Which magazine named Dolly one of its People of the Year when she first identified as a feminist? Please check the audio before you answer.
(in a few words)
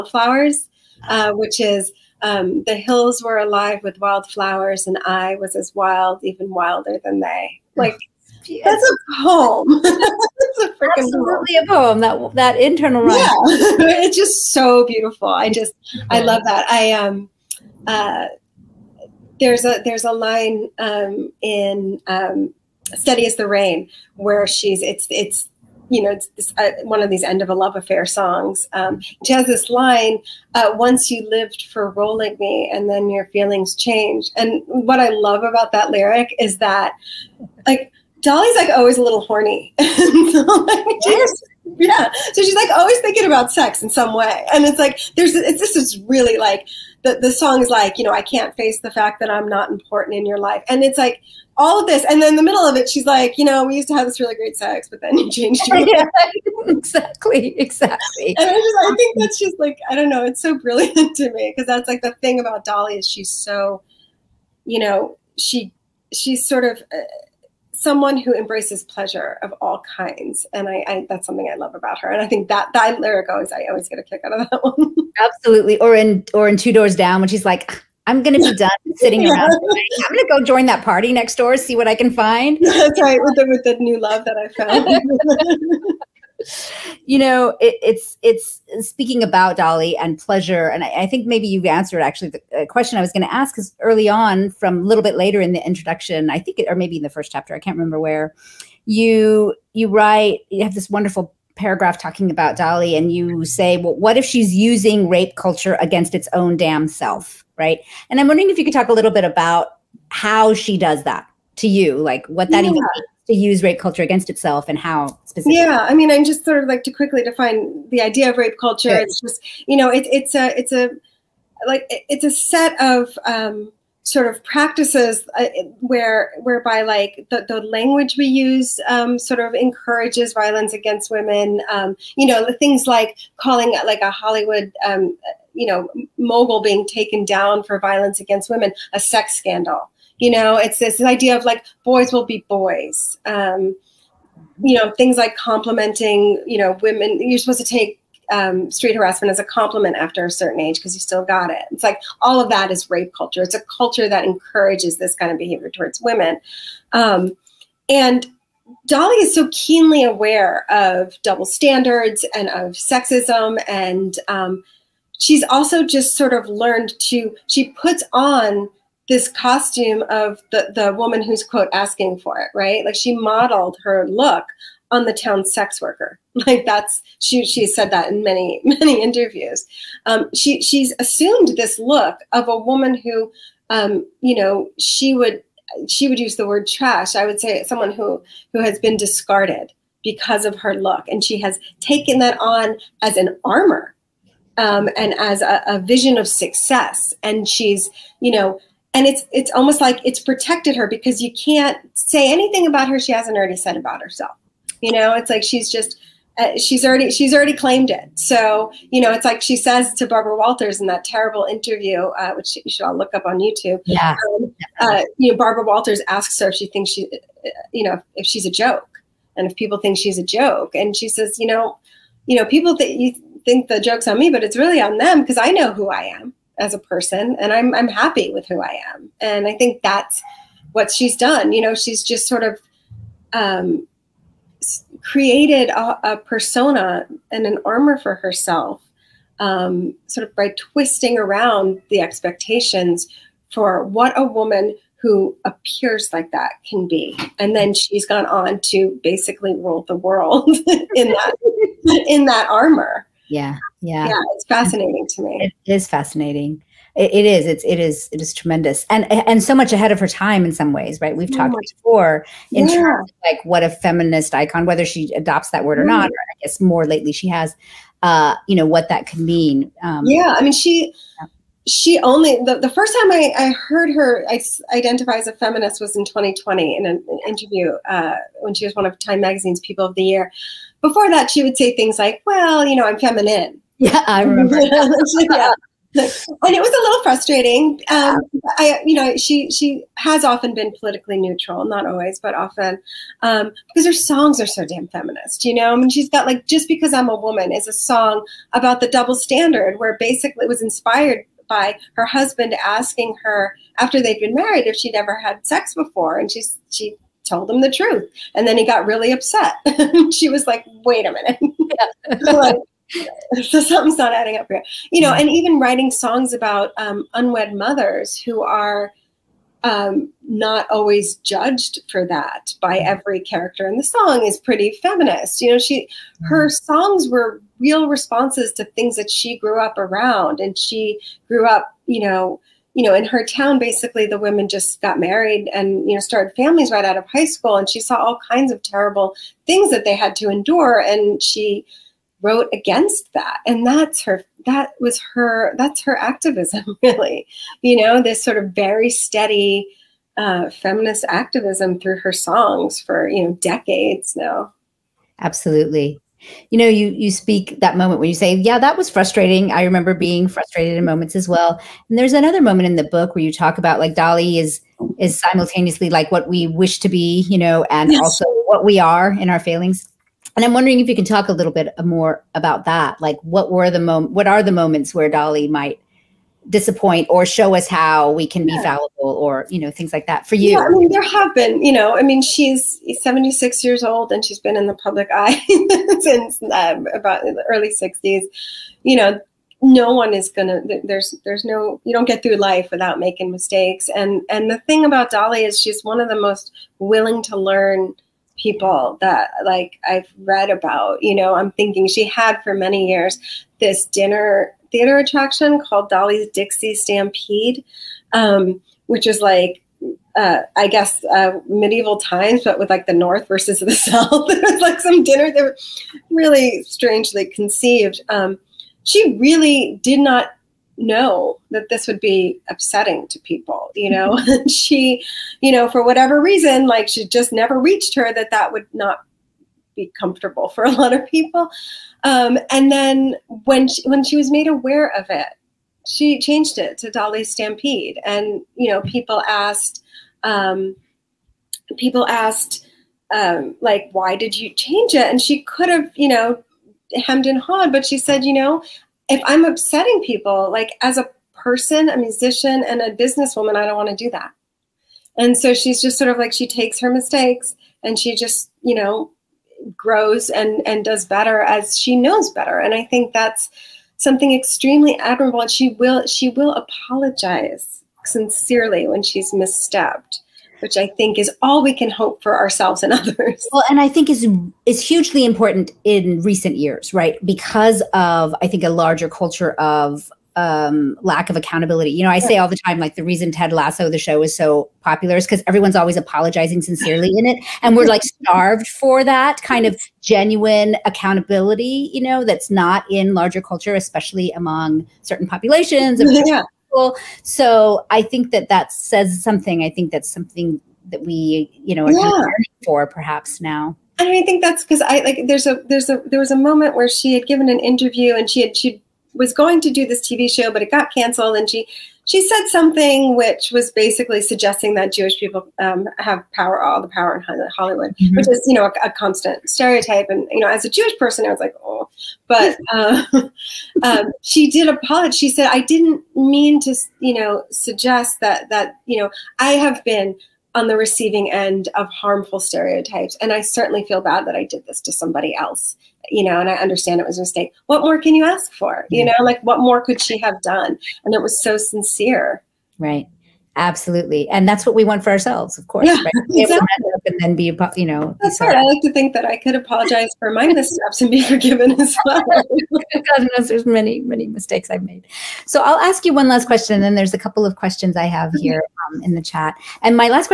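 Time Magazine.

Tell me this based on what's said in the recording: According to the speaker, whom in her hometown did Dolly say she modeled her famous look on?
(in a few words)
The town sex worker.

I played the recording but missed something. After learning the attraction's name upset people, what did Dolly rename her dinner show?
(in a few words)
Dolly Stampede.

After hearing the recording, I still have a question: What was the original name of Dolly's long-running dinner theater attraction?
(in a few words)
Dolly's Dixie Stampede.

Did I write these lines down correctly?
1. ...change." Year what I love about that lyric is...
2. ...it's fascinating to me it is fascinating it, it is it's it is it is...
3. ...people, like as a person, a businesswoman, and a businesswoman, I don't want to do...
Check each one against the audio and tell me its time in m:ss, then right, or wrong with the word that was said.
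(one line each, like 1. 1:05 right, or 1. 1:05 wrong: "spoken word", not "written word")
1. 0:33 wrong: "And", not "Year"
2. 4:14 right
3. 7:30 wrong: "musician", not "businesswoman".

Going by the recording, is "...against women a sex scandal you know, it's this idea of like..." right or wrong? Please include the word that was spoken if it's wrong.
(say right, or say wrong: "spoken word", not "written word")
right.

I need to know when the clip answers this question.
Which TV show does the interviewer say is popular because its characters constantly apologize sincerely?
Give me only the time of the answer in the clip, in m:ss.
8:03.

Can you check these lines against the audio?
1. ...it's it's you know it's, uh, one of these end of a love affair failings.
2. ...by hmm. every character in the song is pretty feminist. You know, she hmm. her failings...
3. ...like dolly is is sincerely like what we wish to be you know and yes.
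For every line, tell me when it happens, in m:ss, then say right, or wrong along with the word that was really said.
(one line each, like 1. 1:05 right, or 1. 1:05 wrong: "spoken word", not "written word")
1. 0:24 wrong: "songs", not "failings"
2. 5:22 wrong: "songs", not "failings"
3. 6:03 wrong: "simultaneously", not "sincerely".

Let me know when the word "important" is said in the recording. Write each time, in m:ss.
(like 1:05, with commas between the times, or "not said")
0:49, 7:55.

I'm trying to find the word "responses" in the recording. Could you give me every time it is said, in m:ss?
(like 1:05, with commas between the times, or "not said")
5:27.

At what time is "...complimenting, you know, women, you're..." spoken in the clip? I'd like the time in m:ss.
2:25.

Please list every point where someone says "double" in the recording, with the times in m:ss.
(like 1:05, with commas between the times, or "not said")
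2:41, 4:58.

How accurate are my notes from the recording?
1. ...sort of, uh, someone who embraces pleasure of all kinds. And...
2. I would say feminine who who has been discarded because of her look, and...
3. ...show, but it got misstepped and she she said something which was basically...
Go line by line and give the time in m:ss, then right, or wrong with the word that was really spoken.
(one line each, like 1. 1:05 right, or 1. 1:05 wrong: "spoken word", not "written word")
1. 1:06 right
2. 3:07 wrong: "someone", not "feminine"
3. 8:30 wrong: "canceled", not "misstepped".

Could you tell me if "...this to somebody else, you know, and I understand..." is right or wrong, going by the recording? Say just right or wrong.
right.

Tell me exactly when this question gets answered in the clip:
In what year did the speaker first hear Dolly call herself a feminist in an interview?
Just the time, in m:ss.
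4:36.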